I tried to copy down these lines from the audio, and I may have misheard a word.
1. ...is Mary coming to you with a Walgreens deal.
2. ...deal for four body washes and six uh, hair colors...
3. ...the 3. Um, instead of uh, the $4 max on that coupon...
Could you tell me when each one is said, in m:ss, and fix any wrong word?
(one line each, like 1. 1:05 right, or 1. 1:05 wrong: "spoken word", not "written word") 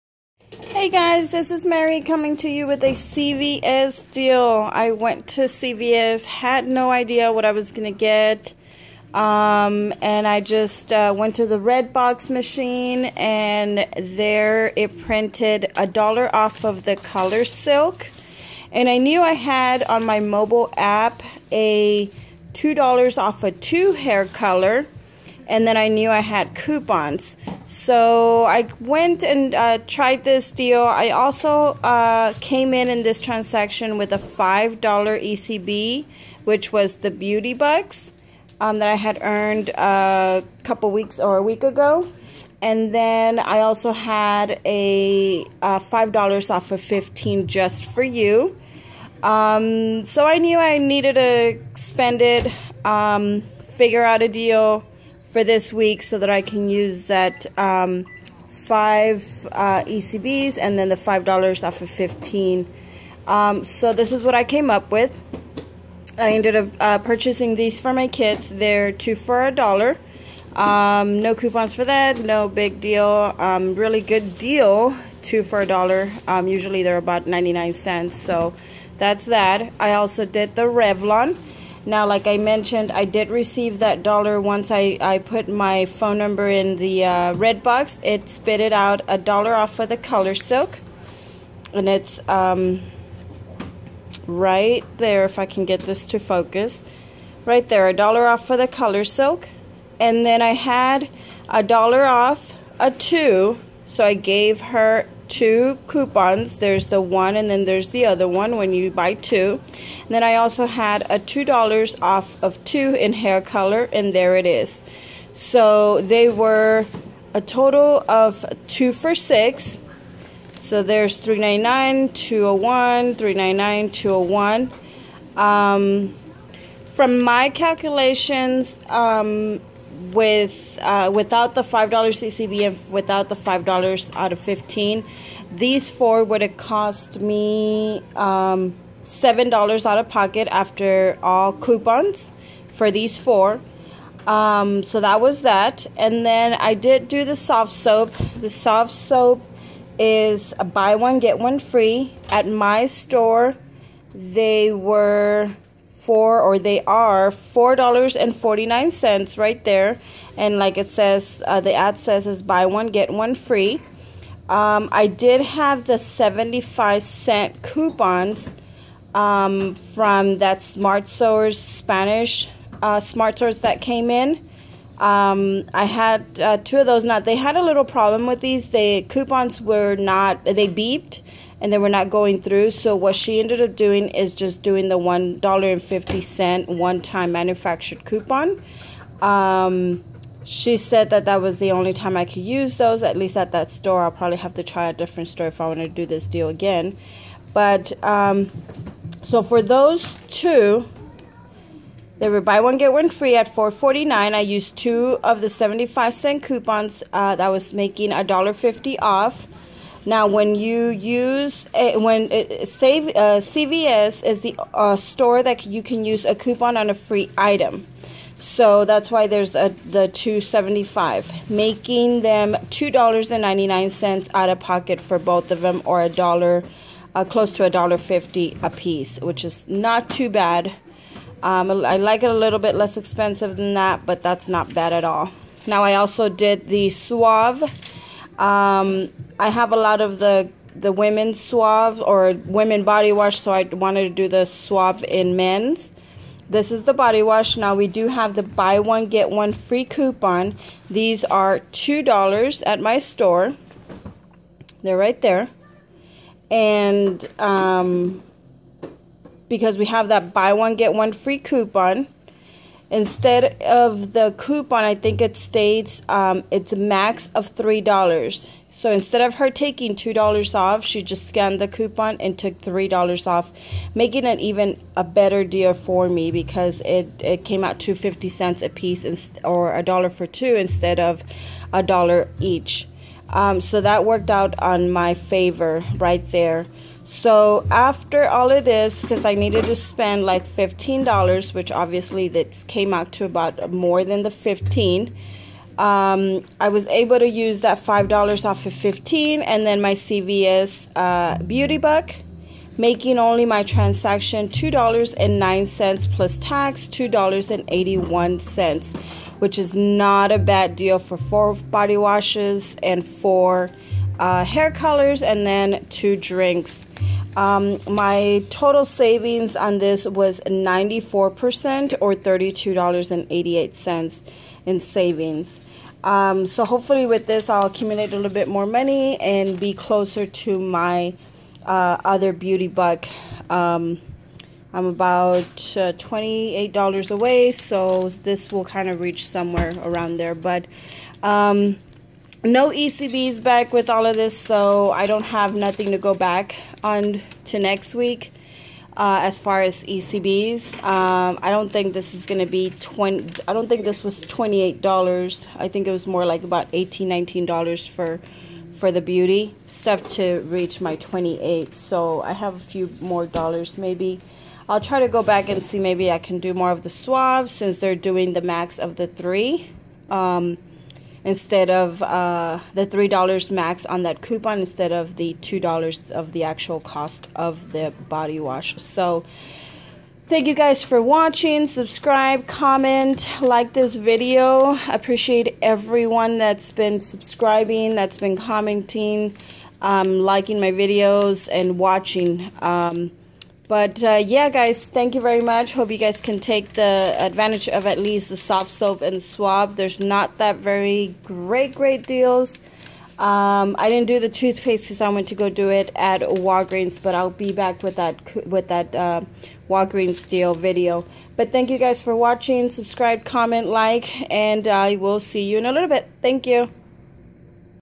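1. 0:01 wrong: "CVS", not "Walgreens"
2. 5:10 wrong: "four", not "six"
3. 6:08 wrong: "3", not "4".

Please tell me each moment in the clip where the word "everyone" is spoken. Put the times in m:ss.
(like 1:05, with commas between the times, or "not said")
6:25.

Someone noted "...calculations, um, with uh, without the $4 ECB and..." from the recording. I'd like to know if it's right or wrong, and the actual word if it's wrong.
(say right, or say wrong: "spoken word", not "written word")
wrong: "5", not "4".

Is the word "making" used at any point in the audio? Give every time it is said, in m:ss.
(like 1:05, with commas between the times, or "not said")
3:27, 3:41, 4:33, 5:02.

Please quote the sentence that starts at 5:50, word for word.
Um, I don't think this is going to be 20 I don't think this was $28.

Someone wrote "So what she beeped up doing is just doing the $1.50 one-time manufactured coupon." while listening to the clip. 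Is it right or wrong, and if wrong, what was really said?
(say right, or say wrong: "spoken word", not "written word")
wrong: "ended", not "beeped".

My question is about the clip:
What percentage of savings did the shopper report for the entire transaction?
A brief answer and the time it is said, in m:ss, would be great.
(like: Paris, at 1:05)
94%, at 5:20.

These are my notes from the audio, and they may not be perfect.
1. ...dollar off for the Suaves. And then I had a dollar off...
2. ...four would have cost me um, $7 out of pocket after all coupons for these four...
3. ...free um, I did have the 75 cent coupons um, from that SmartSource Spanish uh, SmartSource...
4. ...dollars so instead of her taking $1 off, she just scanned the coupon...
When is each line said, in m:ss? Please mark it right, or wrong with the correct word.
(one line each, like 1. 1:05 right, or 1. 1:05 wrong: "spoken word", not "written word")
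1. 1:37 wrong: "ColorSilk", not "Suaves"
2. 2:15 right
3. 2:43 right
4. 4:27 wrong: "2", not "1".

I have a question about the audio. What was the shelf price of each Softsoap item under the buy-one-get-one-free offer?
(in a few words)
$4.49.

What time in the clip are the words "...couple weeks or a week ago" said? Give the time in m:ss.
0:40.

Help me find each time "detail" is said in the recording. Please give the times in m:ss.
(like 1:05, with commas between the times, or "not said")
not said.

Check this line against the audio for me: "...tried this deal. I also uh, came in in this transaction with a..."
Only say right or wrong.
right.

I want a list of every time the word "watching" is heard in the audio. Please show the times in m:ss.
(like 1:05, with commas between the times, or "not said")
6:21, 6:31, 6:52.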